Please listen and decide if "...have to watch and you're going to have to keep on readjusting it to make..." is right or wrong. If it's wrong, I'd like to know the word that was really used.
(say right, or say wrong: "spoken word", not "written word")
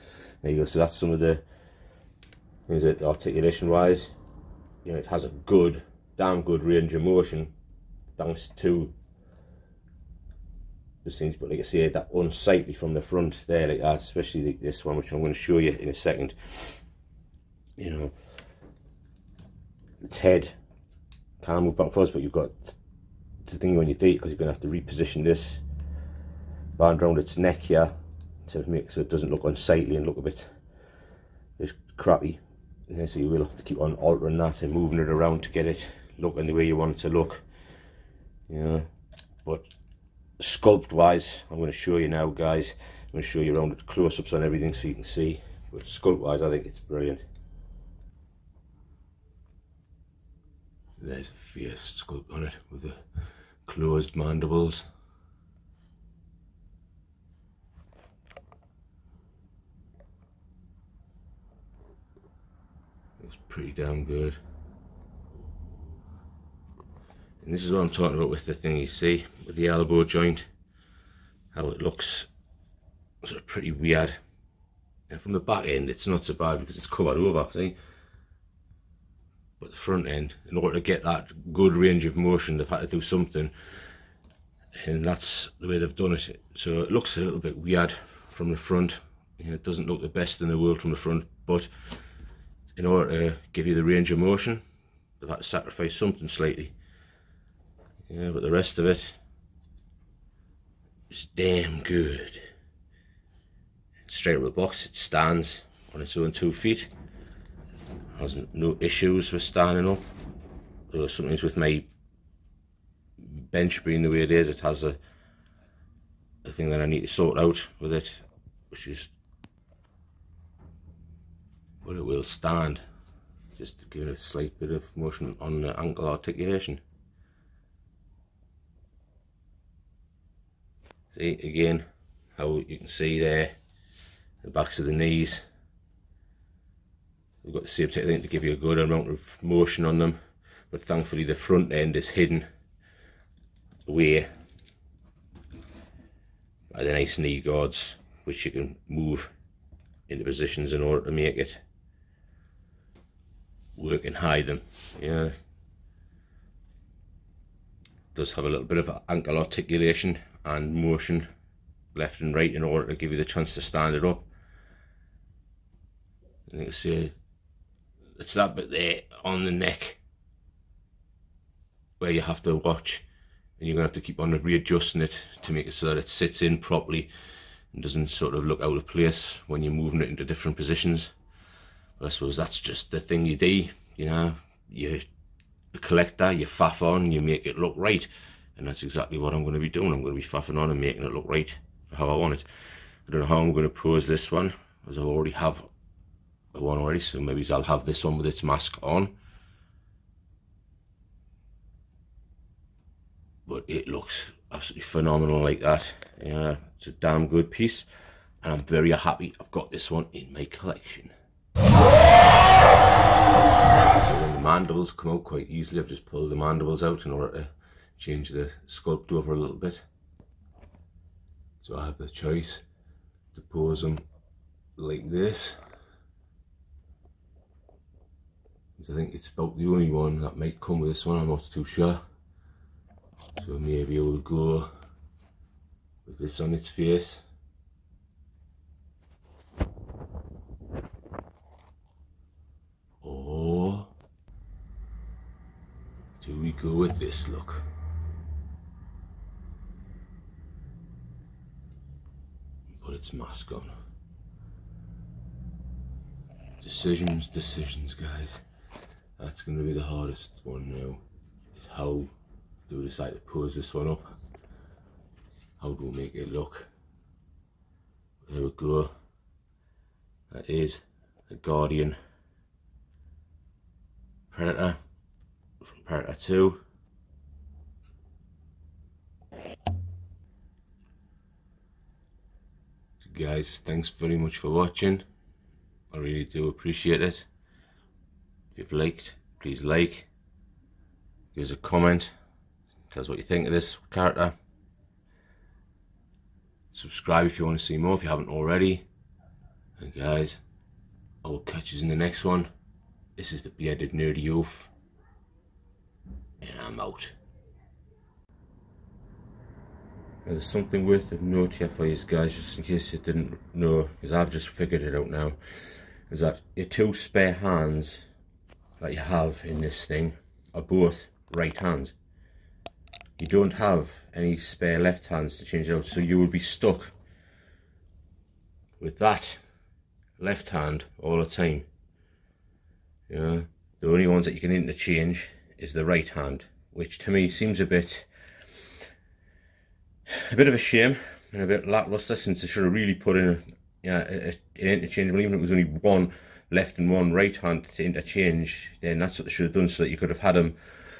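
right.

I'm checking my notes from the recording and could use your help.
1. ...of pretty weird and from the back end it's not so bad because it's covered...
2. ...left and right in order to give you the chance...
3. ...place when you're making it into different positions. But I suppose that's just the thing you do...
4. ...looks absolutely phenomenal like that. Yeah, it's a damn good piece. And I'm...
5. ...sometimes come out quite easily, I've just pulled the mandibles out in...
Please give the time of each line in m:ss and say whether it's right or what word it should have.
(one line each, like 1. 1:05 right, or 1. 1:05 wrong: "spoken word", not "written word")
1. 1:13 right
2. 2:41 right
3. 2:58 wrong: "moving", not "making"
4. 3:23 right
5. 3:34 wrong: "mandibles", not "sometimes".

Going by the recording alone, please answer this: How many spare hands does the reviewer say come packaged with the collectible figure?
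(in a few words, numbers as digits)
2.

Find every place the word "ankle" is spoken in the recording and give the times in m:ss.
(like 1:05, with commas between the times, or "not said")
2:05, 2:39.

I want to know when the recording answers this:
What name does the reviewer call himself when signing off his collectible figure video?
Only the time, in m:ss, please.
5:03.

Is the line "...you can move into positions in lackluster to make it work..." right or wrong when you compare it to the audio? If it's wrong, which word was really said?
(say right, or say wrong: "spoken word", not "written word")
wrong: "order", not "lackluster".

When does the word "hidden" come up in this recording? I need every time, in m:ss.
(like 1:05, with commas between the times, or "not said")
2:22.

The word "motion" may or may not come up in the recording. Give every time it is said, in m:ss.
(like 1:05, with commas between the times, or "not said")
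0:07, 1:22, 1:34, 2:04, 2:19, 2:40.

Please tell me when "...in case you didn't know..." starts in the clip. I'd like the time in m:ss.
5:12.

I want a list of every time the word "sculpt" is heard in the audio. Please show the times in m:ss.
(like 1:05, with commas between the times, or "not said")
0:40, 0:45, 0:52, 3:38.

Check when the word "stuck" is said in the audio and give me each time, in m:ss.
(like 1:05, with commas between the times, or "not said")
5:26.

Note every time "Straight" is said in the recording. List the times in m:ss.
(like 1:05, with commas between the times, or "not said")
1:44.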